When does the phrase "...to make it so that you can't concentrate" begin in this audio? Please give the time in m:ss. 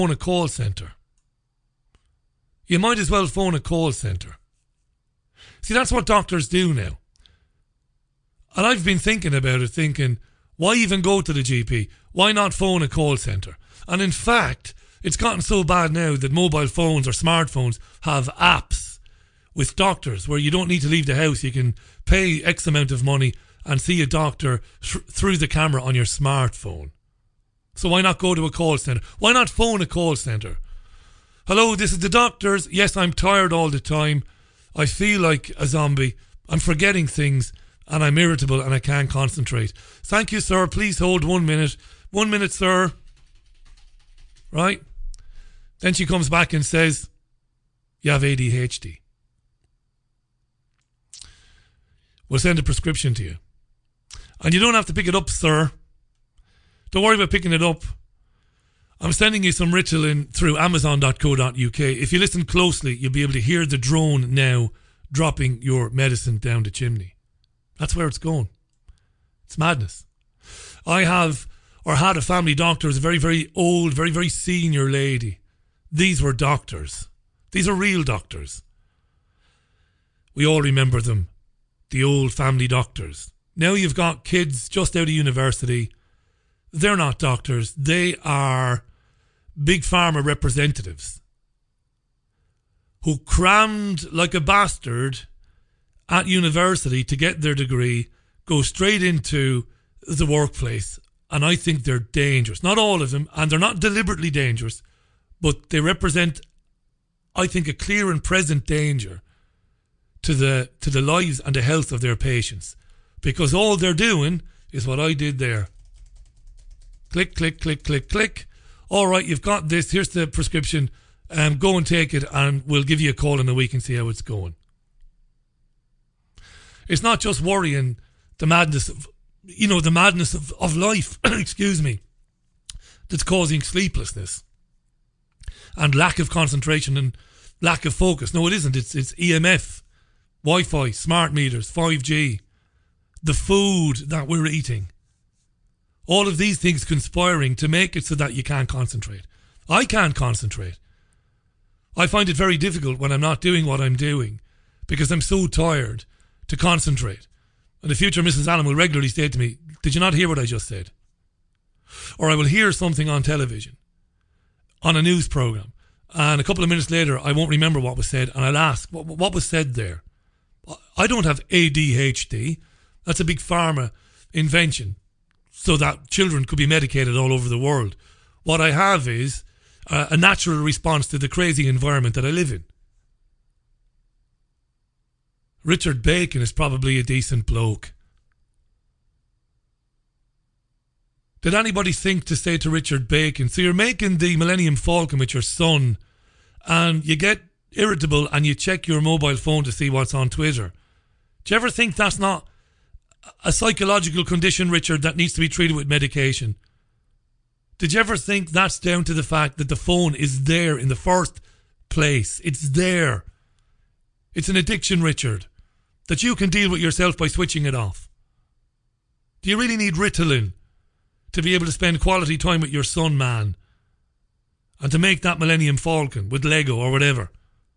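2:27.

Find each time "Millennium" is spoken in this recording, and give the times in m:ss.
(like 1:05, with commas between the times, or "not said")
3:14, 3:45.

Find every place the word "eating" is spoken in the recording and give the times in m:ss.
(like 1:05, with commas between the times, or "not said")
2:24.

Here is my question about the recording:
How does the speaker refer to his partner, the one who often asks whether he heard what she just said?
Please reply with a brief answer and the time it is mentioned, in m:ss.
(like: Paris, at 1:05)
the future Mrs. Allen, at 2:37.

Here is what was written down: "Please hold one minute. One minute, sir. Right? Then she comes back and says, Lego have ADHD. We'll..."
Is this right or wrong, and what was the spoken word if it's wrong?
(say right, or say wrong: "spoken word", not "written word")
wrong: "You", not "Lego".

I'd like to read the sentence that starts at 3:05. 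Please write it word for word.
Richard Bacon is probably a decent bloke.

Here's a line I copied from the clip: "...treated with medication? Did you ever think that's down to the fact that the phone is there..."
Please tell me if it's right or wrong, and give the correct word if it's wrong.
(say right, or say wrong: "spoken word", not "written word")
right.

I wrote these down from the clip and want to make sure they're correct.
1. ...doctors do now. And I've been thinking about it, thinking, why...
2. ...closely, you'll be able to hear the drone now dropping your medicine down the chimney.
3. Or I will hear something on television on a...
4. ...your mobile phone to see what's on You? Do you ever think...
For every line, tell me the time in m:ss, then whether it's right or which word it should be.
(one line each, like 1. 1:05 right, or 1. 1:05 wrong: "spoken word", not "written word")
1. 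0:06 right
2. 1:02 right
3. 2:42 right
4. 3:18 wrong: "Twitter", not "You".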